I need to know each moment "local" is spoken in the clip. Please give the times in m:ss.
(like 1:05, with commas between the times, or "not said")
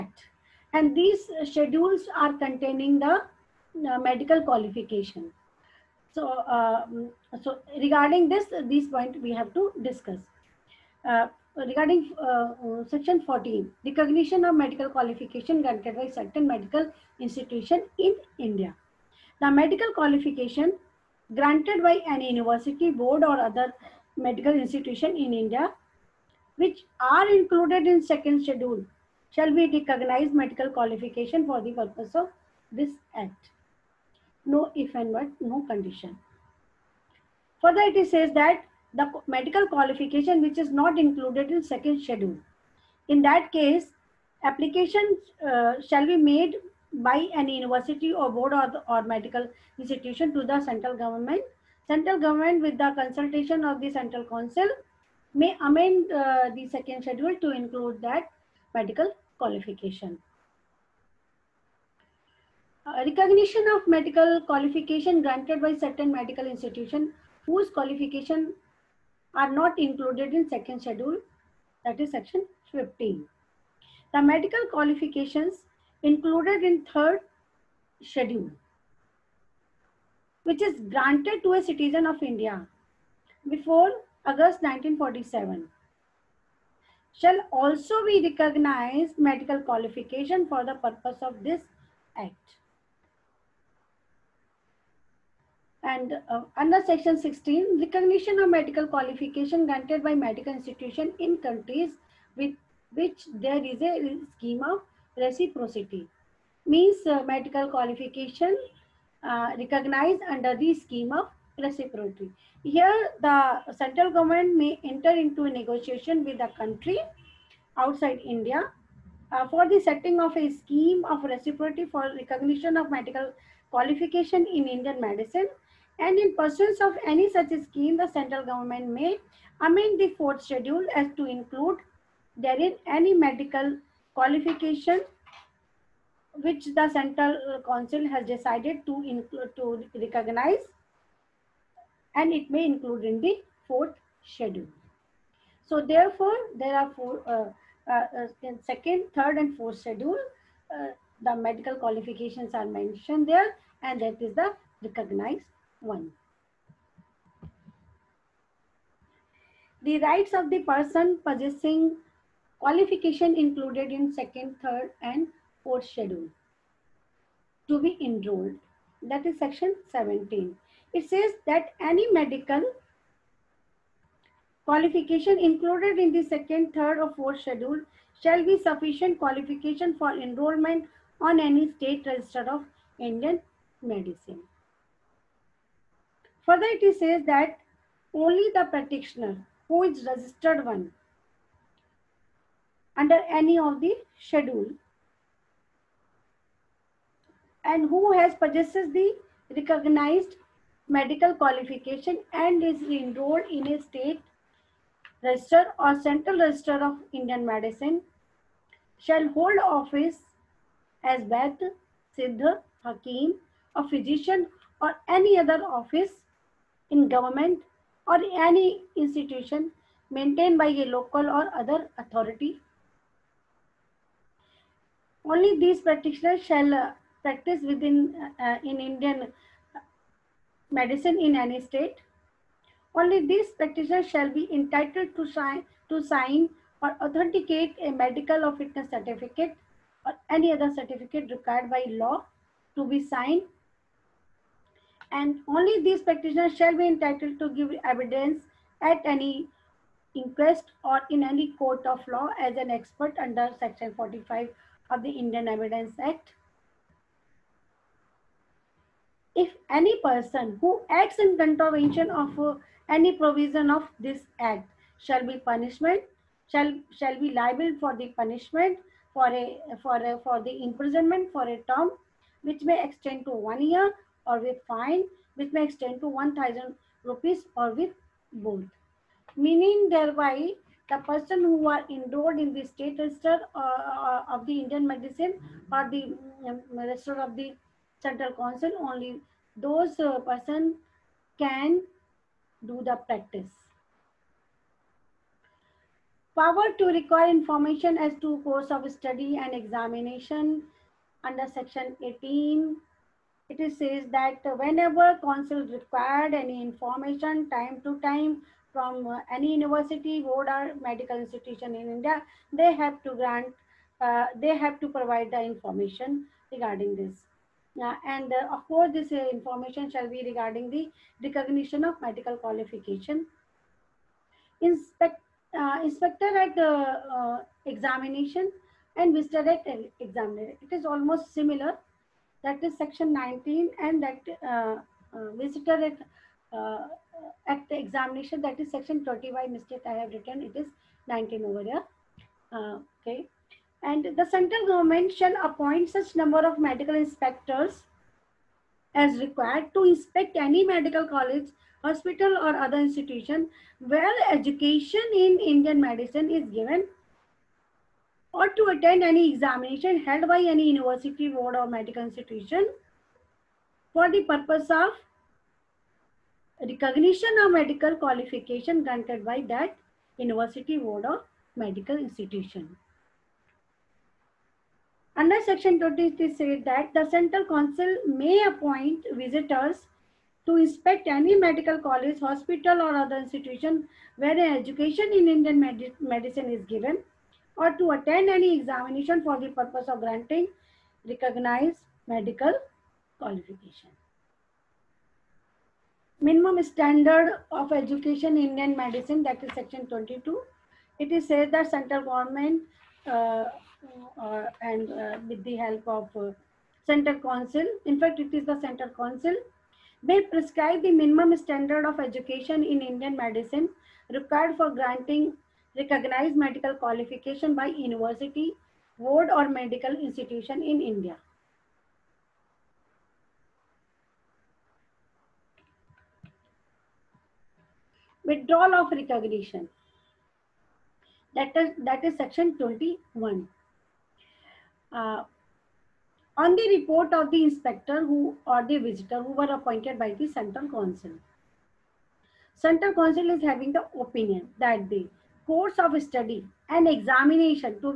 3:40.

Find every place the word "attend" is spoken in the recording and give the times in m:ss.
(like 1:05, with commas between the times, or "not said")
5:58, 6:27.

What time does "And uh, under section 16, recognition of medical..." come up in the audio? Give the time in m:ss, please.
1:35.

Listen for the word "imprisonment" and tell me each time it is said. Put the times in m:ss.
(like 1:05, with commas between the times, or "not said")
4:30.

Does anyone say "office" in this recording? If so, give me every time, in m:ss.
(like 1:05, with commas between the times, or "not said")
3:29, 3:35.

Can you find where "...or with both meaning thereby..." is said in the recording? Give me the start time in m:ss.
4:37.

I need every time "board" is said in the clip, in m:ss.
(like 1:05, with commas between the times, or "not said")
0:22, 0:48, 5:10, 6:01, 6:10, 6:58.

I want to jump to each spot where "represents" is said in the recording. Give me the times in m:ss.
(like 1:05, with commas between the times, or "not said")
not said.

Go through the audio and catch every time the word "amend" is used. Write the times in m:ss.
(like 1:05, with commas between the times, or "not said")
0:55, 2:09.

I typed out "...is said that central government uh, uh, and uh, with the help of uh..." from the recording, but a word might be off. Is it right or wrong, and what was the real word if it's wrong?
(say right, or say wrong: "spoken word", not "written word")
right.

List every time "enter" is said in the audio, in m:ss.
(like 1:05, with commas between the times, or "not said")
1:54.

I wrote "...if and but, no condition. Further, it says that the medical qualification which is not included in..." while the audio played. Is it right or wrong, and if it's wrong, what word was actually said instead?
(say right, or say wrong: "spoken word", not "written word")
right.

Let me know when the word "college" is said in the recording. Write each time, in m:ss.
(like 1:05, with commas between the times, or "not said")
5:51, 6:21.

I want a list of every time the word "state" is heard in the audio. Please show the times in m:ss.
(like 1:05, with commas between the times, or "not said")
3:01, 3:23, 3:51, 4:42.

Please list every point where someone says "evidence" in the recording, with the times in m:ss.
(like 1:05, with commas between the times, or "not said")
4:07, 4:15.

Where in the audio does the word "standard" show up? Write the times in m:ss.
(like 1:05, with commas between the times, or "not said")
6:36, 6:51.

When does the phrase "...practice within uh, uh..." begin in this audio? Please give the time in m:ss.
3:47.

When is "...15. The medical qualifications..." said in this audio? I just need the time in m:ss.
1:12.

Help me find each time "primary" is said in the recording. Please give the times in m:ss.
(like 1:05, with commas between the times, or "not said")
not said.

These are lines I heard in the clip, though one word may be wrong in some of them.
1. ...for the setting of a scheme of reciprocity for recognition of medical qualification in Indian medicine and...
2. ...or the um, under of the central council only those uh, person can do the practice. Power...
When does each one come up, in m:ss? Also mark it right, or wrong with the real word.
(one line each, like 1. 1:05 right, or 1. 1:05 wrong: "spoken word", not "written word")
1. 1:59 right
2. 4:45 wrong: "register", not "under".